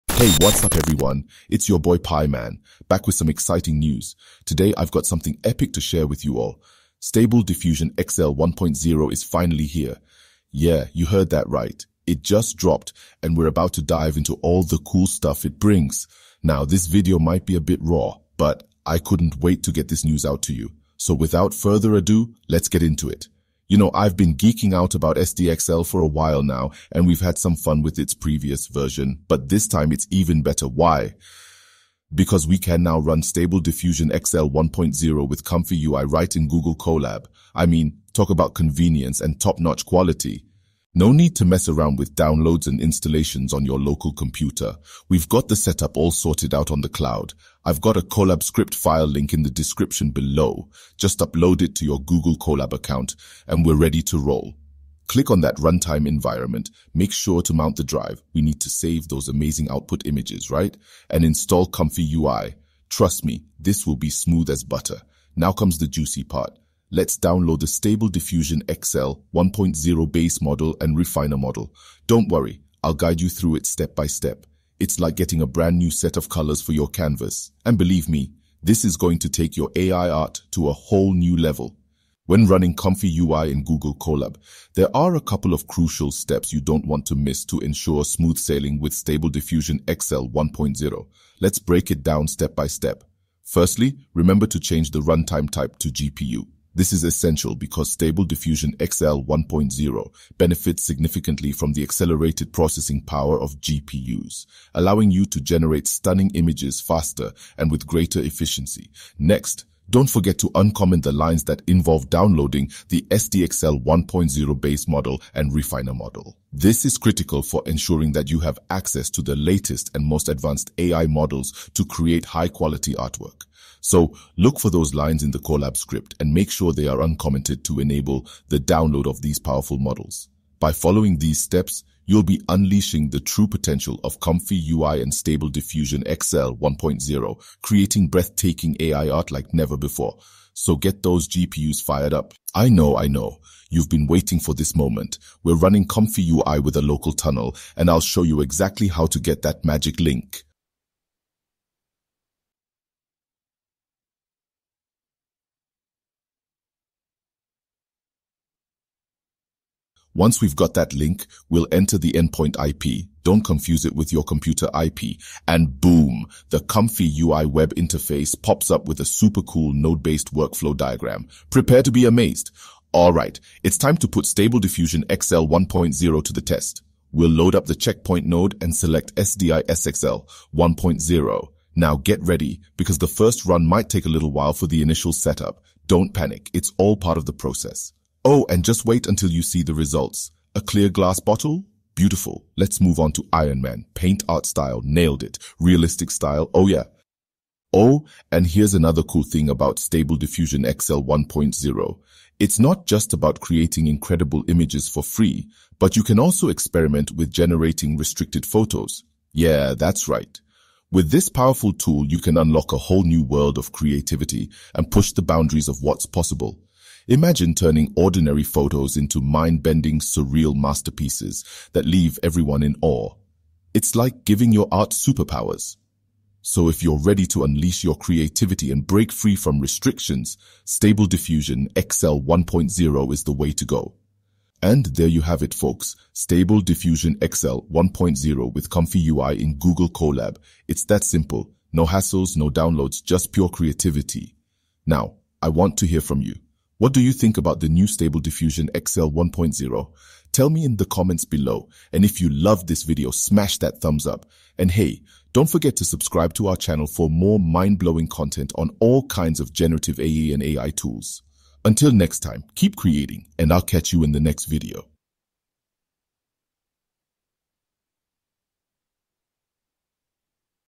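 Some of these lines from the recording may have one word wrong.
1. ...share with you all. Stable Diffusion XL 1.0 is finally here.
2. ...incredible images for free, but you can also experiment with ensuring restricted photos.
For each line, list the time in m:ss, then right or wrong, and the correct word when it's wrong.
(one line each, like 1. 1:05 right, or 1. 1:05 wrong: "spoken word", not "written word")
1. 0:05 right
2. 3:23 wrong: "generating", not "ensuring".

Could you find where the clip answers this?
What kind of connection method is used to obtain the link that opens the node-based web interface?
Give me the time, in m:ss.
2:26.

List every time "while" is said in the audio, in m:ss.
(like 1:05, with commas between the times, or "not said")
0:26, 3:04.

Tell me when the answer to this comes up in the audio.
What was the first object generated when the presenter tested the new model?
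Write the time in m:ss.
3:10.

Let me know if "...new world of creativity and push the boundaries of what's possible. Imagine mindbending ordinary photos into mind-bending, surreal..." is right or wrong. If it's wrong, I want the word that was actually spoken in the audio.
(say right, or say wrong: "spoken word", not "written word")
wrong: "turning", not "mindbending".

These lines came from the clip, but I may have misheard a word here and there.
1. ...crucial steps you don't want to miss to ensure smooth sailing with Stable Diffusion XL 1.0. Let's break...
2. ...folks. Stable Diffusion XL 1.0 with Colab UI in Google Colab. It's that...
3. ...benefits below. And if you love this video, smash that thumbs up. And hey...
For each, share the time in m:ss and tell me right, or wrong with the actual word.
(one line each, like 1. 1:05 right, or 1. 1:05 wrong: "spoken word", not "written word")
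1. 1:25 right
2. 3:55 wrong: "Comfy", not "Colab"
3. 4:10 wrong: "comments", not "benefits".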